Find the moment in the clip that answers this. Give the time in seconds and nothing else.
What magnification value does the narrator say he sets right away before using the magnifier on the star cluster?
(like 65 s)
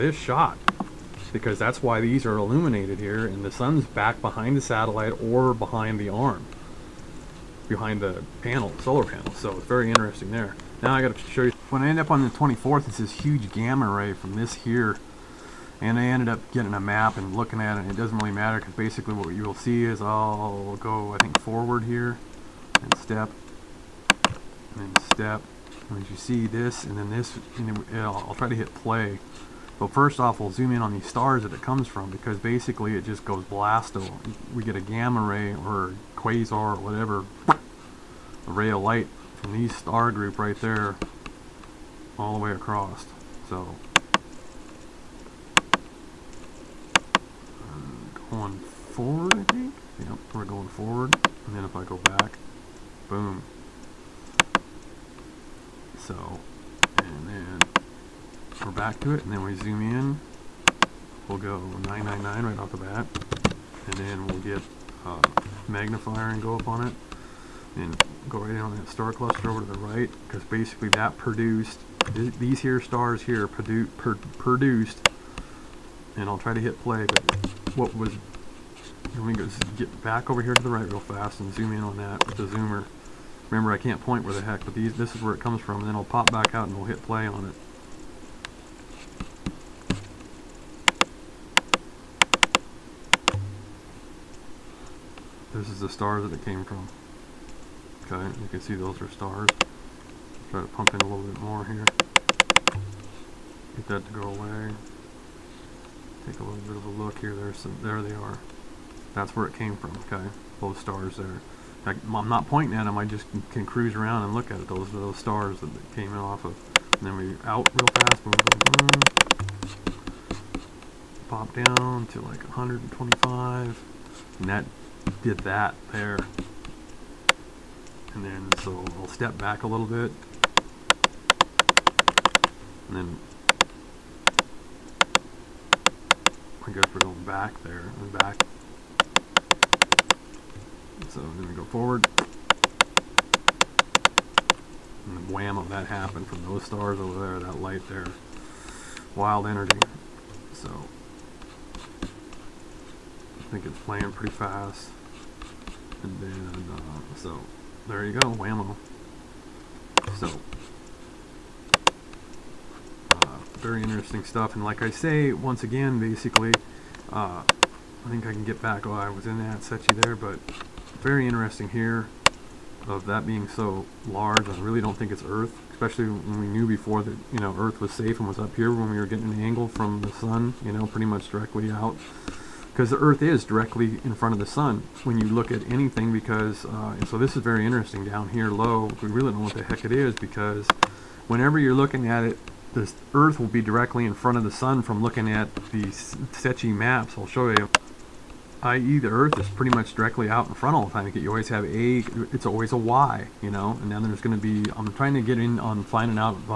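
61 s.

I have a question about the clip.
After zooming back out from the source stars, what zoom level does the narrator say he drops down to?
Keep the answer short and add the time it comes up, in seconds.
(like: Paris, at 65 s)
125, at 122 s.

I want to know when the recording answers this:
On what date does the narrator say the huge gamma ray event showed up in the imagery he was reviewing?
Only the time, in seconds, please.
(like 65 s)
12 s.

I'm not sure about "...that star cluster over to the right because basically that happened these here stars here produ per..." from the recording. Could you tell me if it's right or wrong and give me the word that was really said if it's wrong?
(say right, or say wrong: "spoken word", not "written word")
wrong: "produced", not "happened".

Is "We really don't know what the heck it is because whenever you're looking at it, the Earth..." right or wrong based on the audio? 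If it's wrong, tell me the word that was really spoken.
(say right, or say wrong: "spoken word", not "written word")
right.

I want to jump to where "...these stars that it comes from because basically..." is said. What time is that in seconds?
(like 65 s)
30 s.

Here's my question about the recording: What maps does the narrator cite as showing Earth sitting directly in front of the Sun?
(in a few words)
SECCHI maps.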